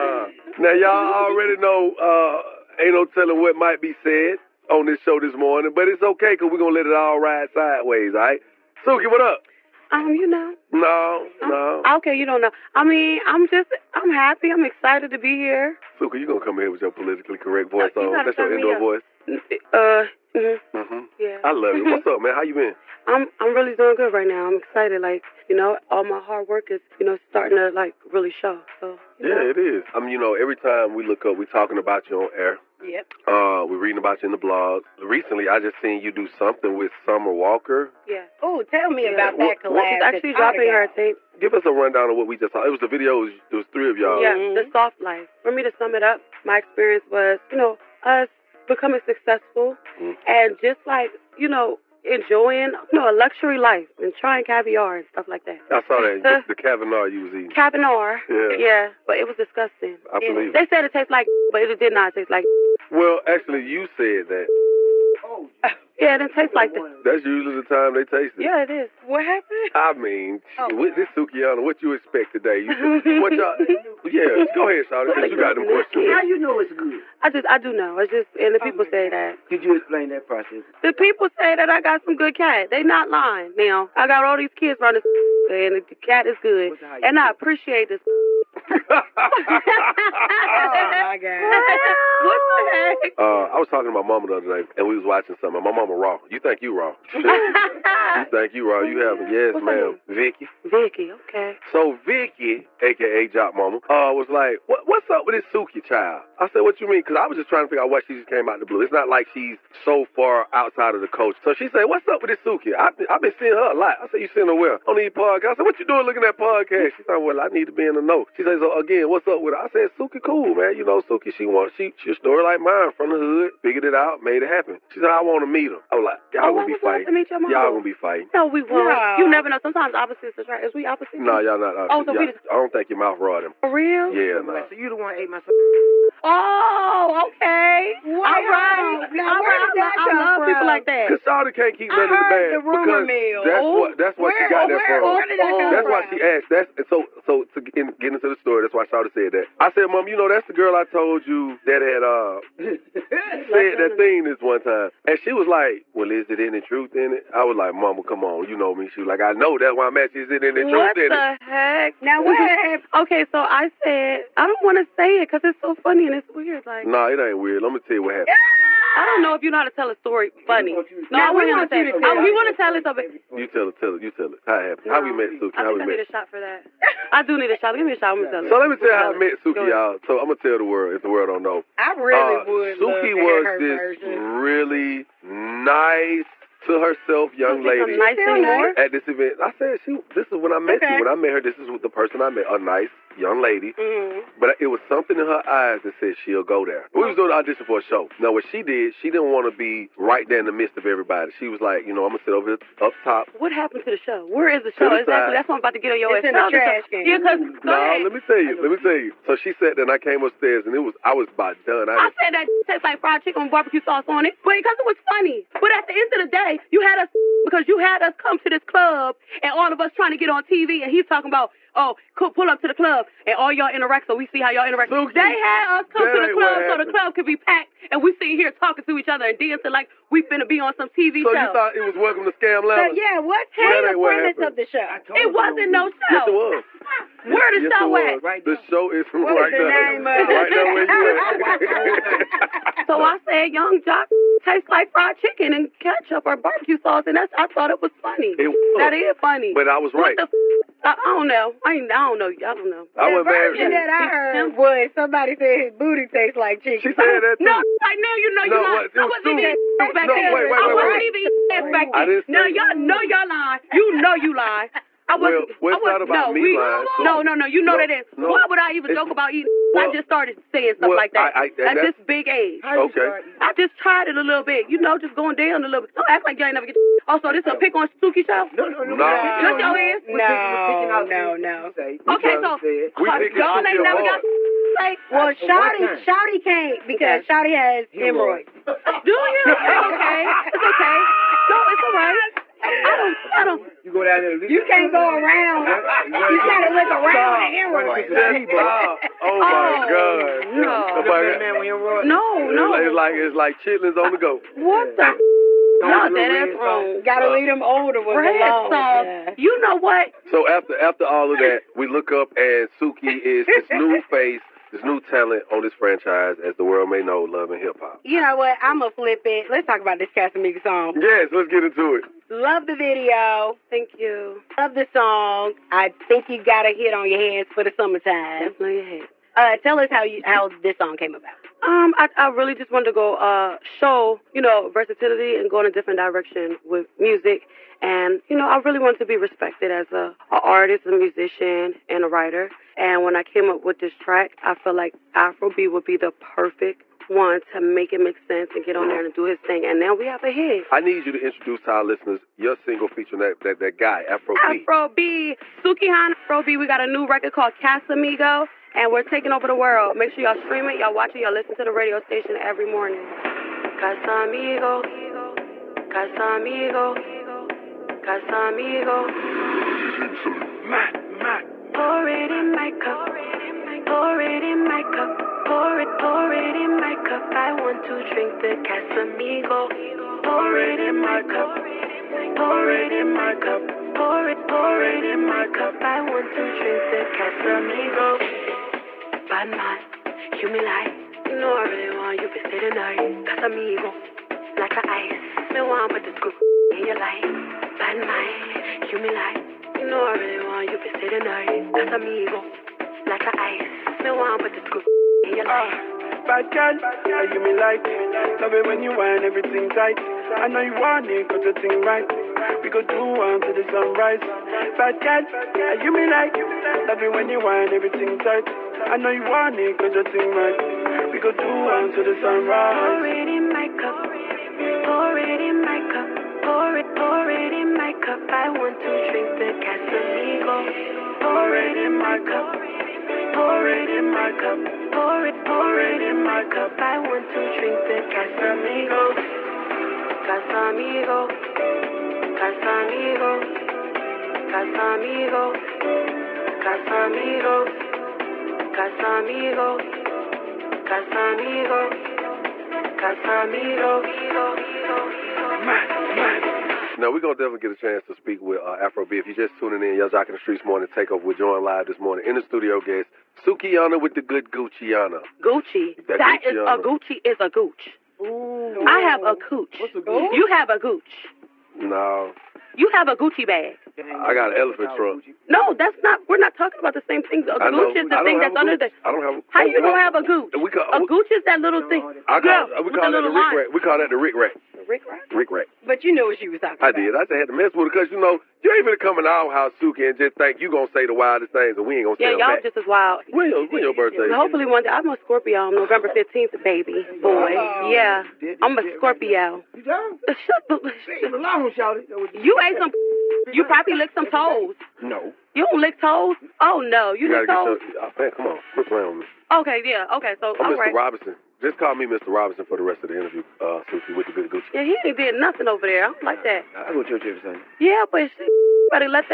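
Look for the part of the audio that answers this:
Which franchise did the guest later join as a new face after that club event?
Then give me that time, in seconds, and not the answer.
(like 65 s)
317 s.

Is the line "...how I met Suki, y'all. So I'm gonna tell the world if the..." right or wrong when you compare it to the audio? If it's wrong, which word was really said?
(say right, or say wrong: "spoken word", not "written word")
right.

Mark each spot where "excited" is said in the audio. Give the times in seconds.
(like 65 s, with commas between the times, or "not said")
14 s, 24 s.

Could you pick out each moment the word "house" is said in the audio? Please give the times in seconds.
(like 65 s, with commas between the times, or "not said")
489 s.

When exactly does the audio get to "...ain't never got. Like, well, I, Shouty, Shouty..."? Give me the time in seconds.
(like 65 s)
283 s.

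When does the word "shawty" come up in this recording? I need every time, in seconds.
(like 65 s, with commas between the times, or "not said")
74 s, 141 s, 148 s, 501 s.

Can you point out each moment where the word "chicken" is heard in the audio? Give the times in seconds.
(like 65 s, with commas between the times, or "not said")
213 s, 245 s, 256 s.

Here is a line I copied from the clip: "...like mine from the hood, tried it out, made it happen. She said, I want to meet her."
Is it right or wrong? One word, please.
wrong.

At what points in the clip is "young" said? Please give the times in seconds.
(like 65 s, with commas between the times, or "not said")
187 s, 193 s.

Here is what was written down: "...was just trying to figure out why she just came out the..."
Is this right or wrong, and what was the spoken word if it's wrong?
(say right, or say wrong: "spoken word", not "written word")
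right.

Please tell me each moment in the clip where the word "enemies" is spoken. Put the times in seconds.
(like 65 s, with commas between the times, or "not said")
not said.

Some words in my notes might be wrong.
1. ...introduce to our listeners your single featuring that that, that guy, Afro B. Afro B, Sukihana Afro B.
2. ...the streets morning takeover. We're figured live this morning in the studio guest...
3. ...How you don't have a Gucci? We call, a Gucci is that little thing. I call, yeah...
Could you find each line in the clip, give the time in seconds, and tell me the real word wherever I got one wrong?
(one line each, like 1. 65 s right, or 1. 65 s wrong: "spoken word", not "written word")
1. 351 s right
2. 460 s wrong: "joined", not "figured"
3. 479 s right.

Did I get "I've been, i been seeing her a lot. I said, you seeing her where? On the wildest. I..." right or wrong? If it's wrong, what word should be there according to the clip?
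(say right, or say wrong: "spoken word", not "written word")
wrong: "podcast", not "wildest".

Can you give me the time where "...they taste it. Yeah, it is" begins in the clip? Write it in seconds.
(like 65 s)
67 s.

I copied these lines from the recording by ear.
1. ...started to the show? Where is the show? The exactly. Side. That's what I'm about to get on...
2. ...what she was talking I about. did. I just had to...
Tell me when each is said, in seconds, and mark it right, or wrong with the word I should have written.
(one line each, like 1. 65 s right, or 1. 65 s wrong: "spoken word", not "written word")
1. 203 s wrong: "happened", not "started"
2. 486 s right.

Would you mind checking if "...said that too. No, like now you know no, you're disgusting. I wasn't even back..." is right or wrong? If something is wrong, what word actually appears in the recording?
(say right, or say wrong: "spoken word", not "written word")
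wrong: "lying", not "disgusting".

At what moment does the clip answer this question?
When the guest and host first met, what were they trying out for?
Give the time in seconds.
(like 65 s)
197 s.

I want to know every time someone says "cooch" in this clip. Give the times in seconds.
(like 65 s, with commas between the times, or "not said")
469 s.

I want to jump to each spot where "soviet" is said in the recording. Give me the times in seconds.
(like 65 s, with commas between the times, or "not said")
not said.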